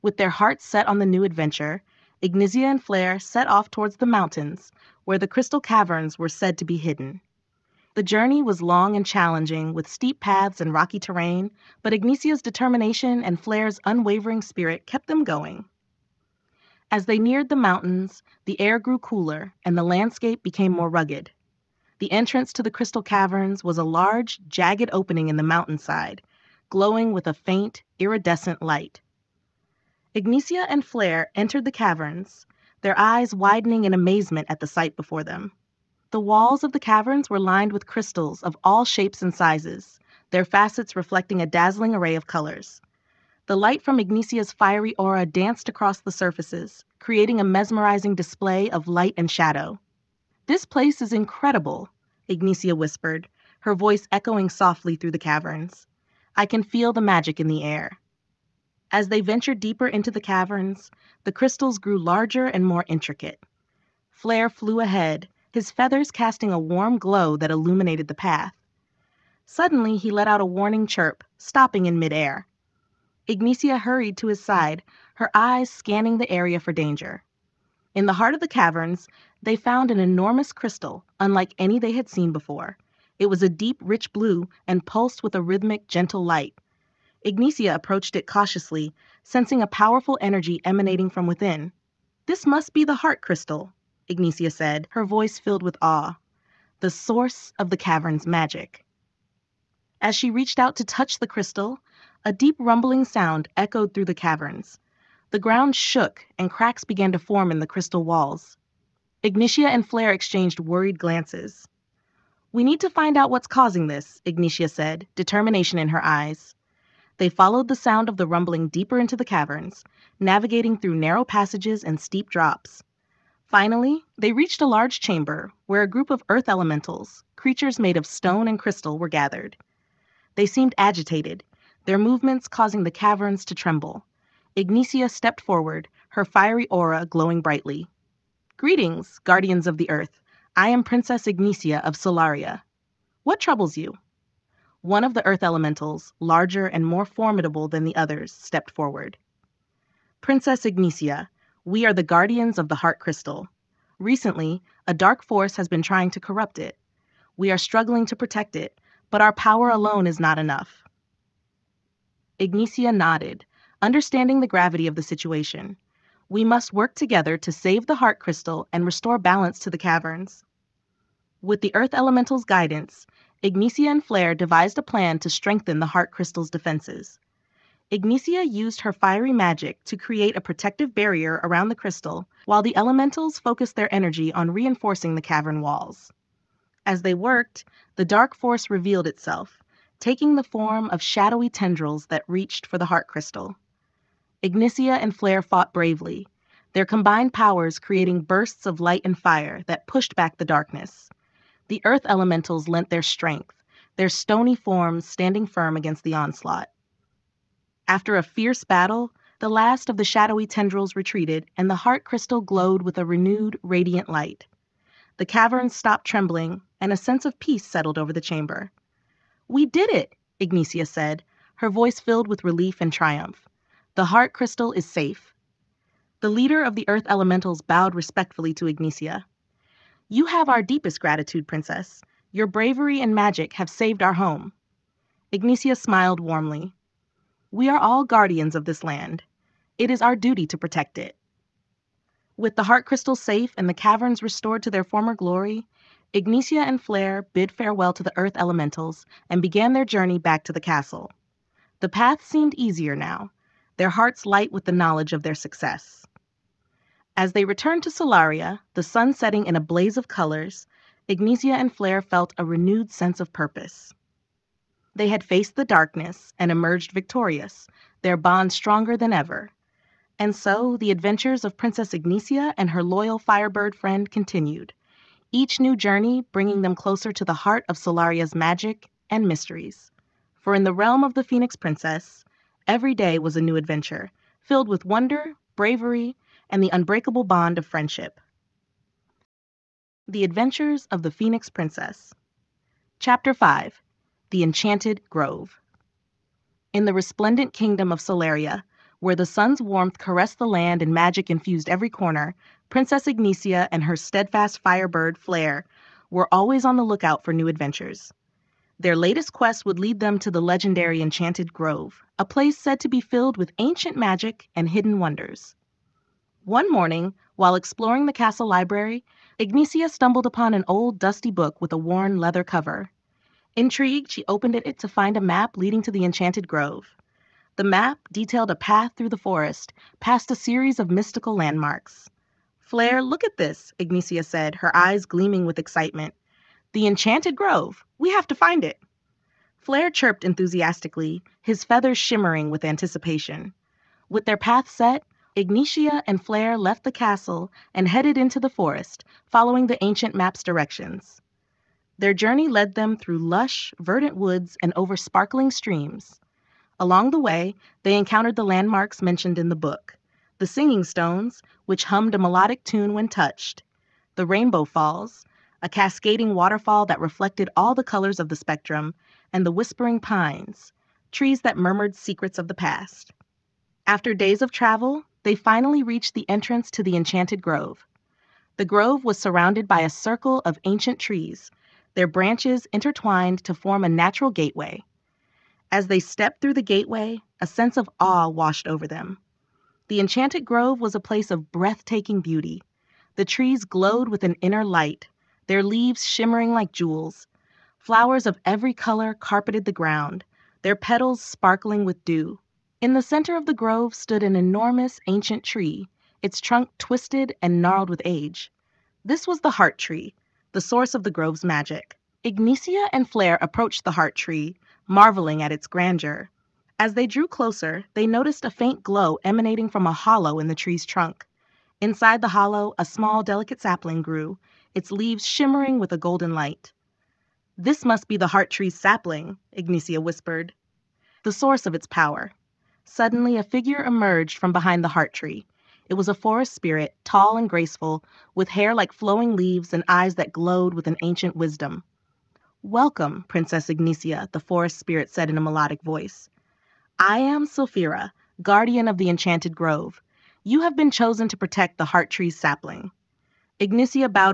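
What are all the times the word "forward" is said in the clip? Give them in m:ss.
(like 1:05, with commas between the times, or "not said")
2:15, 2:28.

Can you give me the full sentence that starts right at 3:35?
The cavern stopped trembling, and a sense of peace settled over the chamber.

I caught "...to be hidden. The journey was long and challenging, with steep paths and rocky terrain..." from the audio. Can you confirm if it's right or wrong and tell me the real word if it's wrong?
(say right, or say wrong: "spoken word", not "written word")
right.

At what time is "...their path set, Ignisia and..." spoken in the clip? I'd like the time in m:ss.
5:44.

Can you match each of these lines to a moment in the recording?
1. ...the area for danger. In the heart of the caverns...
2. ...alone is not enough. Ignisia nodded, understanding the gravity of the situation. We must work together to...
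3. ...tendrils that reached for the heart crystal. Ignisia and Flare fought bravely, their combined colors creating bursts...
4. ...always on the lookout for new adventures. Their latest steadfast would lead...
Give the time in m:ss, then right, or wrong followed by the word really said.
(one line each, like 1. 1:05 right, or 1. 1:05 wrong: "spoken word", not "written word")
1. 1:16 right
2. 2:39 right
3. 3:11 wrong: "powers", not "colors"
4. 5:06 wrong: "quest", not "steadfast".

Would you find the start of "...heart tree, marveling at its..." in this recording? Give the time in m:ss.
6:53.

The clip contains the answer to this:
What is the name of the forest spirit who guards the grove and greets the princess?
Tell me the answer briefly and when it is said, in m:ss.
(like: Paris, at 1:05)
Sylphira, at 7:27.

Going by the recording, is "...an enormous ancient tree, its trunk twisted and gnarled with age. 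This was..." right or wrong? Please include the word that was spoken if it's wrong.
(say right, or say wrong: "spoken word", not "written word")
right.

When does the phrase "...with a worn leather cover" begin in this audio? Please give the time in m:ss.
5:21.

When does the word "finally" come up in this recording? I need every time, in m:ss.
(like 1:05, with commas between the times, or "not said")
2:03, 6:15.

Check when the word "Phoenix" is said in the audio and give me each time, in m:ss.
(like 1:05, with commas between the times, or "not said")
4:41, 4:51.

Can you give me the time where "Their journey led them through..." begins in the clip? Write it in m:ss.
5:52.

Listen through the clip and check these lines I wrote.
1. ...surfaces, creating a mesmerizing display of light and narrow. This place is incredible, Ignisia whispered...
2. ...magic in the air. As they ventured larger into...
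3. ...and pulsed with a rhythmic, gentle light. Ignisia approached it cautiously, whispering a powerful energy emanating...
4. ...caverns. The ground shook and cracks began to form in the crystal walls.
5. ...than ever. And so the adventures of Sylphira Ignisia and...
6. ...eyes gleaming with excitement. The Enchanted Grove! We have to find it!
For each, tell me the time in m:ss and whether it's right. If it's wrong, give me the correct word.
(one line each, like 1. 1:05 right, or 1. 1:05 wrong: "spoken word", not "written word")
1. 0:46 wrong: "shadow", not "narrow"
2. 0:57 wrong: "deeper", not "larger"
3. 1:24 wrong: "sensing", not "whispering"
4. 1:44 right
5. 4:28 wrong: "Princess", not "Sylphira"
6. 5:34 right.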